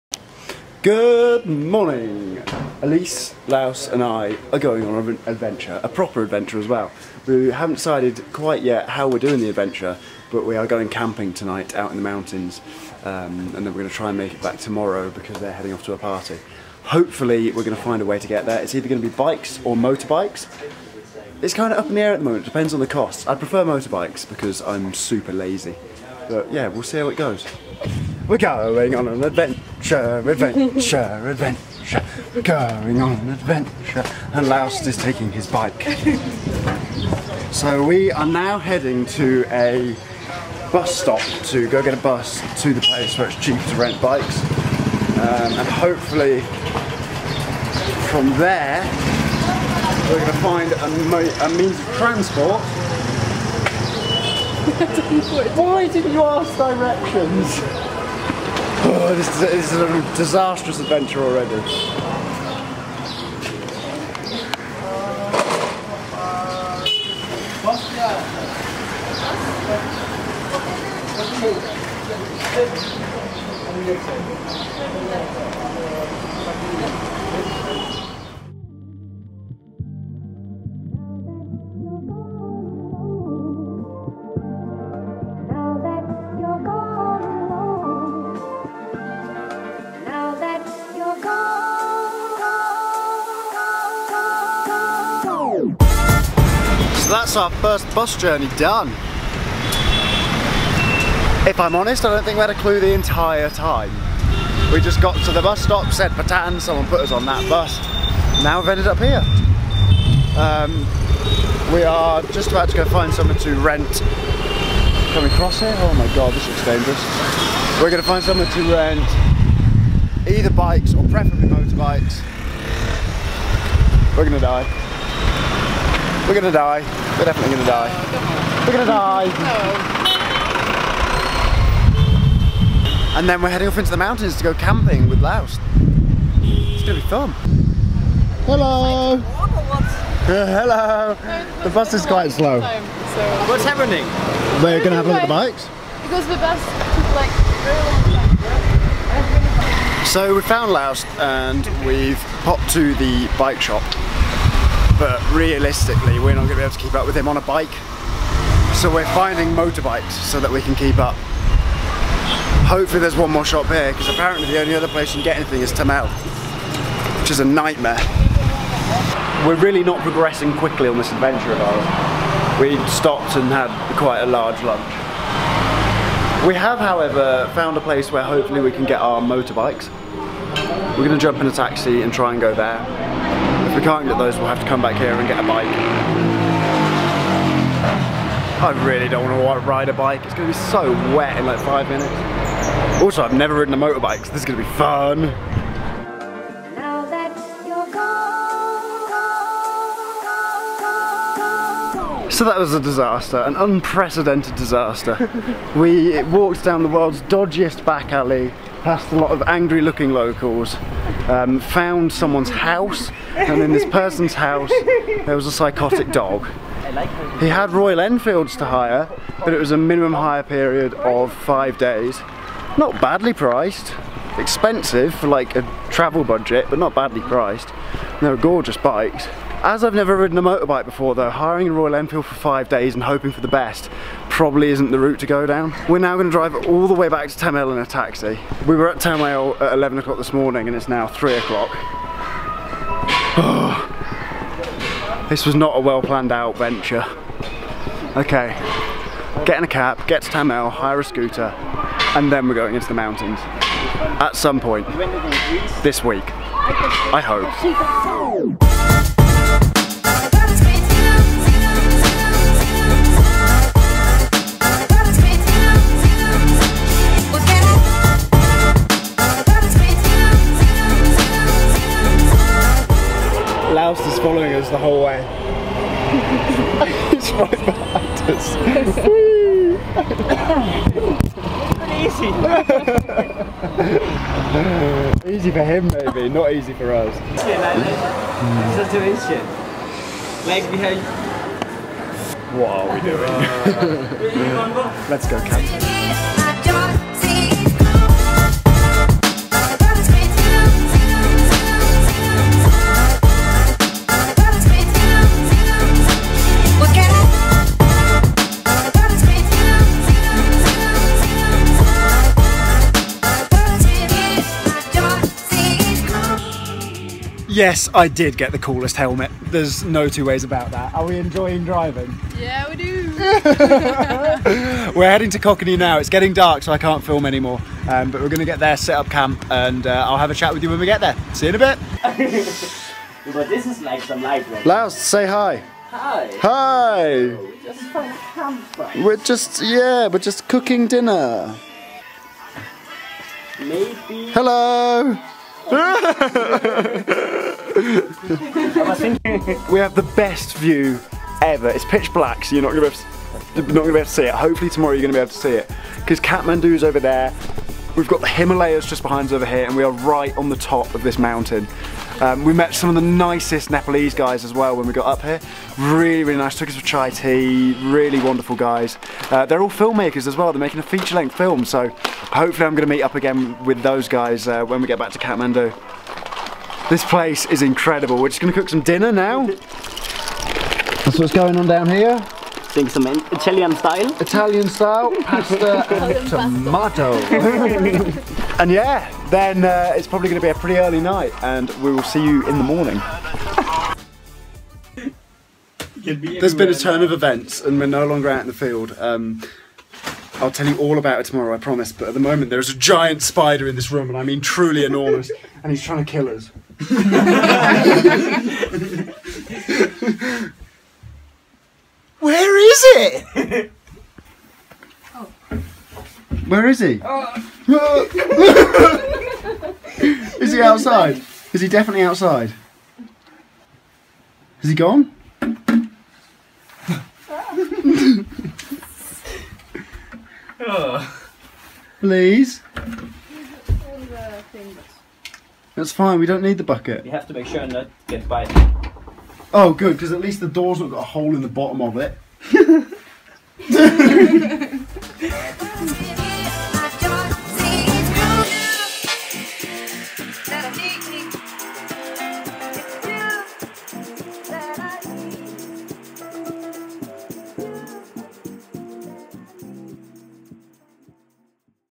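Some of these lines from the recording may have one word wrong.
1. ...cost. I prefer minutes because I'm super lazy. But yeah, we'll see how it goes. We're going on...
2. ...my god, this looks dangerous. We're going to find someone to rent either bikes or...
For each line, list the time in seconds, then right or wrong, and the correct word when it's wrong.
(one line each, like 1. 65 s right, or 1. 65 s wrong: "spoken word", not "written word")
1. 22 s wrong: "motorbikes", not "minutes"
2. 115 s right.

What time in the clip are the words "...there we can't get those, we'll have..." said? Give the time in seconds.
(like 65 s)
182 s.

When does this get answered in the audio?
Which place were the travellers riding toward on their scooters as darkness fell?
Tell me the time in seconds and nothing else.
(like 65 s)
325 s.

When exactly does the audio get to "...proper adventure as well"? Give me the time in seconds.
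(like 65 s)
5 s.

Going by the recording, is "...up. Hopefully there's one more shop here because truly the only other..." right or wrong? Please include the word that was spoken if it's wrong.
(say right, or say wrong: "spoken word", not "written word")
wrong: "apparently", not "truly".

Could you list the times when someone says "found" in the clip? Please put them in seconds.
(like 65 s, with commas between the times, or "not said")
150 s, 177 s, 211 s.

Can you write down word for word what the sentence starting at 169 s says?
We're really not progressing quickly on this adventure of ours.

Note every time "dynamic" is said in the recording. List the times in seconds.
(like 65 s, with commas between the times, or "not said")
not said.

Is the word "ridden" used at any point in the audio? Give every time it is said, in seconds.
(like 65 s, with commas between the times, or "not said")
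193 s, 230 s.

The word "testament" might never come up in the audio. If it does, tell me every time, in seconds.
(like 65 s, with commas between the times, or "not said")
not said.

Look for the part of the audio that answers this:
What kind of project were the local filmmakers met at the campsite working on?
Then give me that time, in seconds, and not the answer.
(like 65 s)
370 s.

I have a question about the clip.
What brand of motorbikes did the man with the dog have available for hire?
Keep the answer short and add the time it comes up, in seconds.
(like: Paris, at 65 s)
Royal Enfield, at 217 s.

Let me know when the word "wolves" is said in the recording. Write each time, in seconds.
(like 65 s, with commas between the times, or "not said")
not said.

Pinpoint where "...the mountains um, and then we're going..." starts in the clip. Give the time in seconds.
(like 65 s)
11 s.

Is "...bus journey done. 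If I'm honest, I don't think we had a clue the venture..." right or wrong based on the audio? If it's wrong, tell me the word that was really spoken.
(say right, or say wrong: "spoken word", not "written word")
wrong: "entire", not "venture".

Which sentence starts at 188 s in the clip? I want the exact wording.
I really don't want to ride a bike.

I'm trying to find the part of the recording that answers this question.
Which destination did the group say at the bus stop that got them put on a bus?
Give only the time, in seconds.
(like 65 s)
106 s.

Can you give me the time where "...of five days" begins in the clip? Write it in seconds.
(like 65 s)
220 s.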